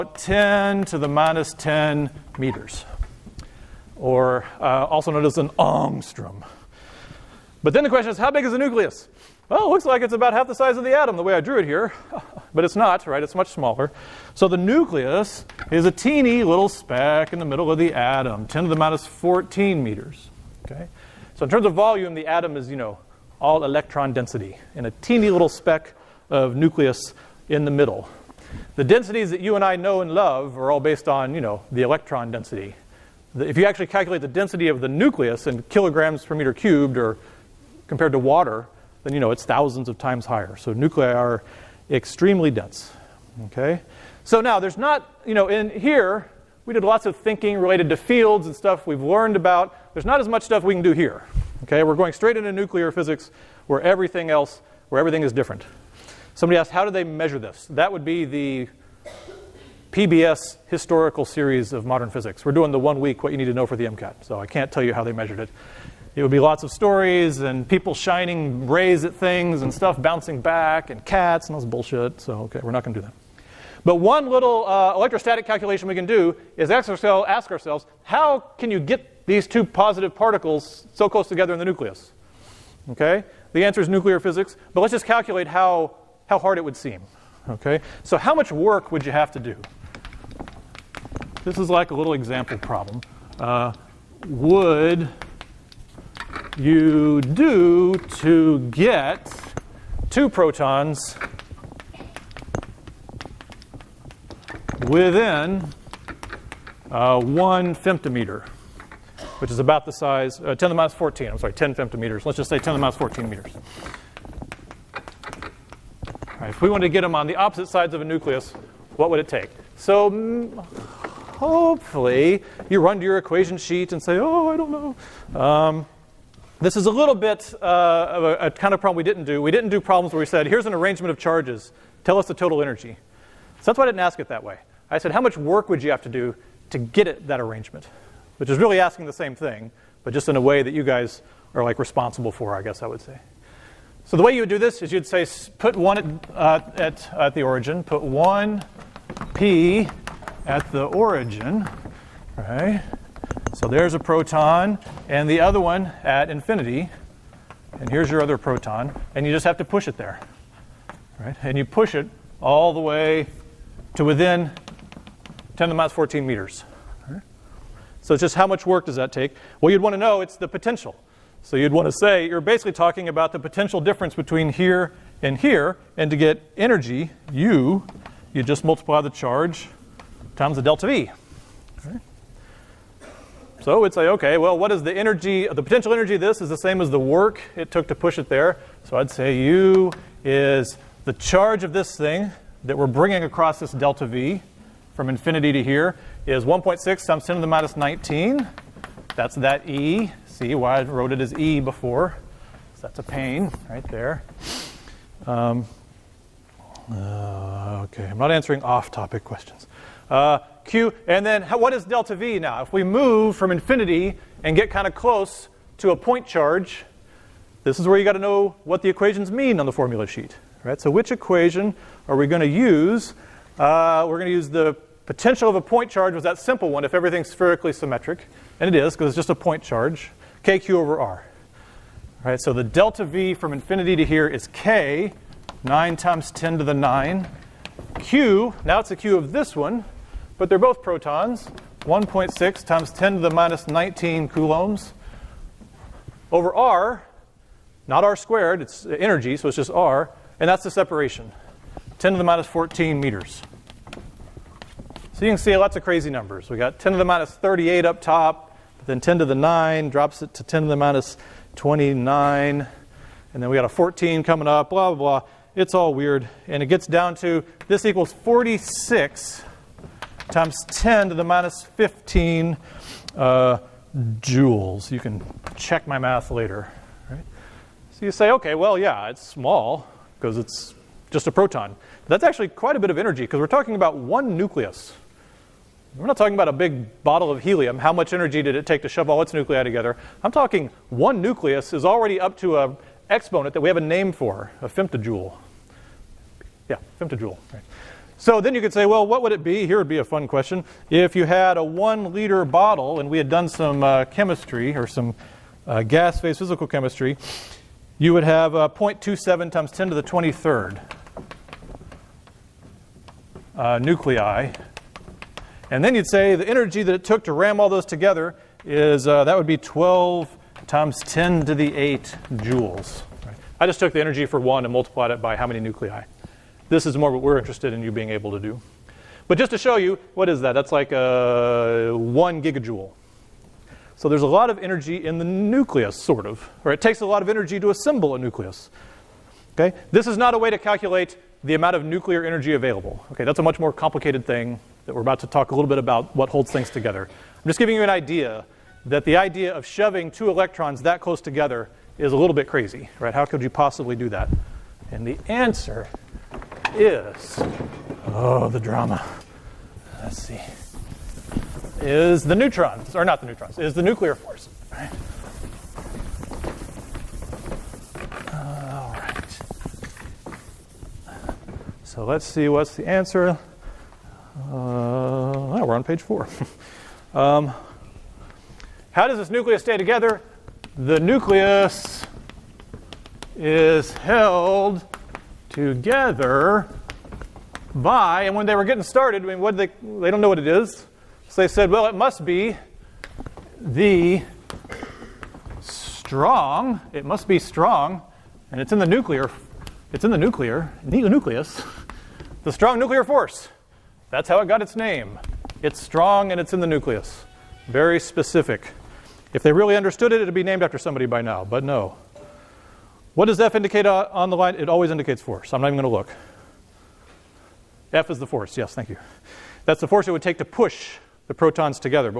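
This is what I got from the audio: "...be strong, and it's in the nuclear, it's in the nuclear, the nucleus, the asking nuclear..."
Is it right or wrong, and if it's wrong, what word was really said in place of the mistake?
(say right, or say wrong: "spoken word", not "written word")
wrong: "strong", not "asking".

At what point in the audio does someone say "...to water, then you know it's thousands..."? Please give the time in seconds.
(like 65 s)
38 s.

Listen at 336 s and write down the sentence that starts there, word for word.
Or it takes a lot of energy to assemble a nucleus.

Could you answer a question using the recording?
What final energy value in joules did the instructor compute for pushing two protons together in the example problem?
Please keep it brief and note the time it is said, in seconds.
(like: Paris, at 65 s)
46 × 10^-15 joules, at 268 s.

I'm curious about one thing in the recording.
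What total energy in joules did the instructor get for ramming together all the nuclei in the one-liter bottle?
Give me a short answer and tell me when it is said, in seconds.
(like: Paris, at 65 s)
12 × 10^8 joules, at 319 s.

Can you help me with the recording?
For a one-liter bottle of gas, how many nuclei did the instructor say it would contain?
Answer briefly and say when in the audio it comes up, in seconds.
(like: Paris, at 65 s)
0.27 × 10^23, at 308 s.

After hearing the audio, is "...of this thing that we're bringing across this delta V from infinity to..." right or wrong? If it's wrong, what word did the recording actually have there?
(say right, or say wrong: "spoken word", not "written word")
right.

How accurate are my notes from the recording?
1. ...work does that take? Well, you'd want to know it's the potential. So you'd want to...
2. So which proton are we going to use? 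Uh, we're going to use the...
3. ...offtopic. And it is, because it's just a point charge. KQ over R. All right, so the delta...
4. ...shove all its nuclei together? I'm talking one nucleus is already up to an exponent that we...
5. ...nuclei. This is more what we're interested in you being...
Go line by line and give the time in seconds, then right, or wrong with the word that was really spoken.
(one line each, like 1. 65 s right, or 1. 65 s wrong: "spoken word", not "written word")
1. 168 s right
2. 220 s wrong: "equation", not "proton"
3. 227 s wrong: "symmetric", not "offtopic"
4. 288 s right
5. 325 s right.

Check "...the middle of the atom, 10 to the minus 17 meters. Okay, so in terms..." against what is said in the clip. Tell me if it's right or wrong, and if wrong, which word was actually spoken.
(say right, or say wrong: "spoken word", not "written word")
wrong: "14", not "17".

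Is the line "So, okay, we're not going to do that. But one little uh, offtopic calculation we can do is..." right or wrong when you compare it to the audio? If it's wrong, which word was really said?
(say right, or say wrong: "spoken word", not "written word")
wrong: "electrostatic", not "offtopic".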